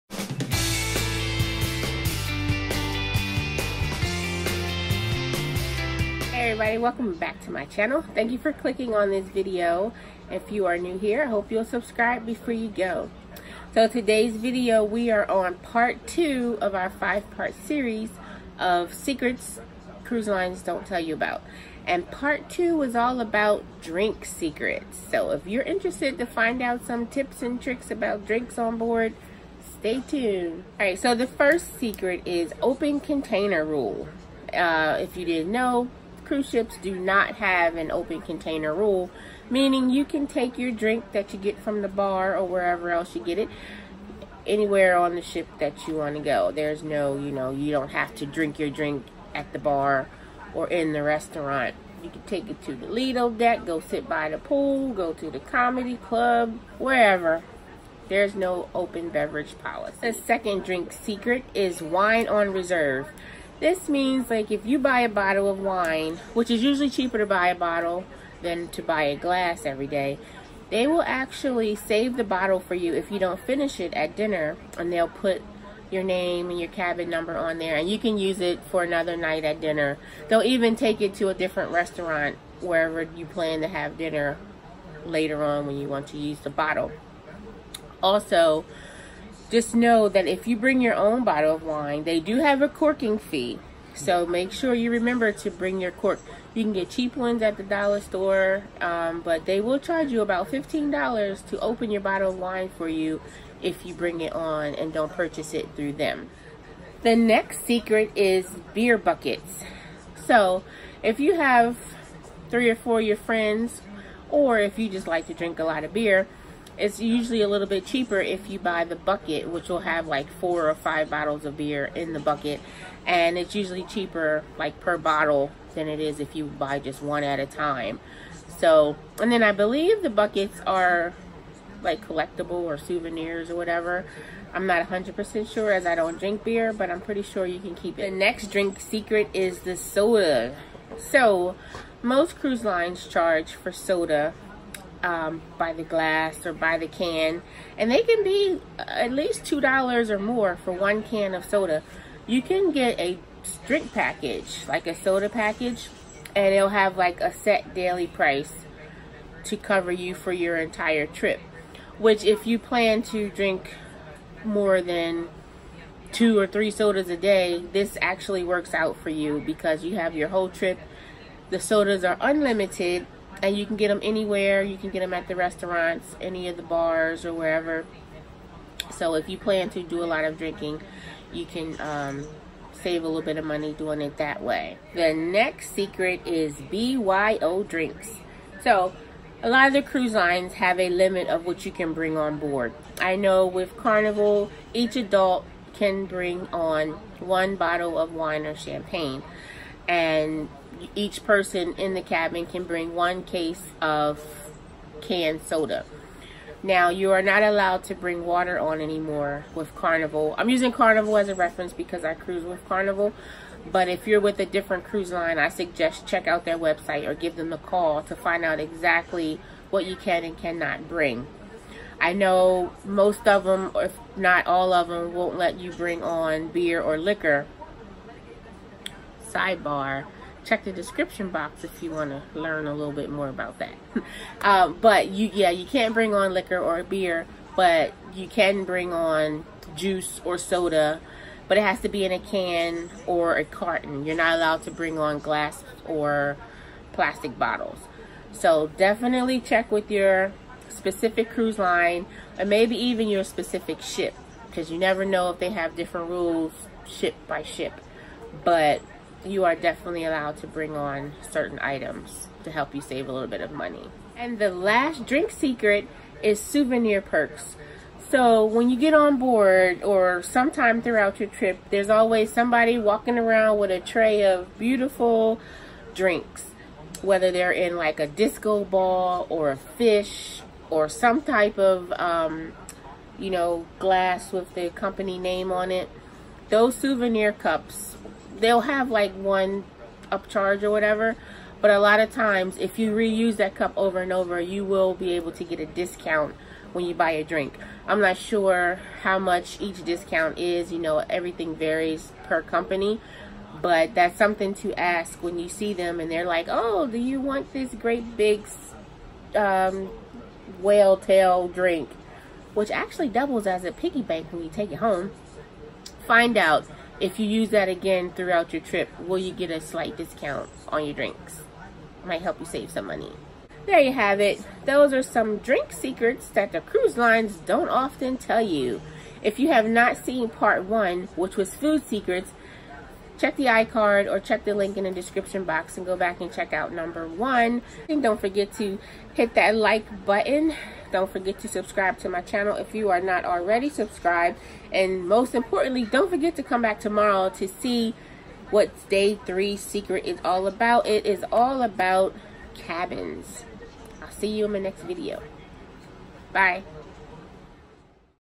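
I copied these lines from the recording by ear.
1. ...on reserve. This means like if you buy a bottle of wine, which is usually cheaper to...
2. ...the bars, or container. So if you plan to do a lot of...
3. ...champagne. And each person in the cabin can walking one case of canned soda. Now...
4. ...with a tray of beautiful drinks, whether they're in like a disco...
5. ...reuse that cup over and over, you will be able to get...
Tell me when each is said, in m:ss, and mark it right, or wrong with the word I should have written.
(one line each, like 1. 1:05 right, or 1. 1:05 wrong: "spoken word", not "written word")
1. 1:02 right
2. 2:56 wrong: "wherever", not "container"
3. 3:18 wrong: "bring", not "walking"
4. 4:33 right
5. 4:52 right.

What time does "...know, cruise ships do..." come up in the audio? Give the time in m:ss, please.
0:35.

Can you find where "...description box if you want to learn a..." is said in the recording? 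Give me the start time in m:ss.
3:50.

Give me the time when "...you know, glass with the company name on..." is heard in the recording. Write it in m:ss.
4:43.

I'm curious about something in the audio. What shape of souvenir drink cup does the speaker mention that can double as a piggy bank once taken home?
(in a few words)
whale tail.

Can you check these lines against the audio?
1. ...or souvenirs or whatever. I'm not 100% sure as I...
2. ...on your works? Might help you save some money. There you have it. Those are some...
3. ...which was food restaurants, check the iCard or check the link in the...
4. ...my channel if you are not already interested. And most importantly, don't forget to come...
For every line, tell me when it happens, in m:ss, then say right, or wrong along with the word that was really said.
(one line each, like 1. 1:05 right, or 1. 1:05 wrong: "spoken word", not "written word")
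1. 2:12 right
2. 5:20 wrong: "drinks", not "works"
3. 5:31 wrong: "secrets", not "restaurants"
4. 5:42 wrong: "subscribed", not "interested".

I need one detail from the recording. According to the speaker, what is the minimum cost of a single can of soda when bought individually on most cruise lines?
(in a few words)
$2.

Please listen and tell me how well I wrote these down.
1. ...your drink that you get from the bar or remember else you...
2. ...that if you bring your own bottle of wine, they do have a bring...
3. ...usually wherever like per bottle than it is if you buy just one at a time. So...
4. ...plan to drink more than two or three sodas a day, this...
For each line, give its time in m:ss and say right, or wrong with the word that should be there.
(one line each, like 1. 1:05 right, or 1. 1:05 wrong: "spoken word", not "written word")
1. 0:40 wrong: "wherever", not "remember"
2. 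1:30 wrong: "corking", not "bring"
3. 2:03 wrong: "cheaper", not "wherever"
4. 2:42 right.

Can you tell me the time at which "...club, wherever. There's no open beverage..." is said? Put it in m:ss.
0:55.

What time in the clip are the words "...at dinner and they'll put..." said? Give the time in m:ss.
1:13.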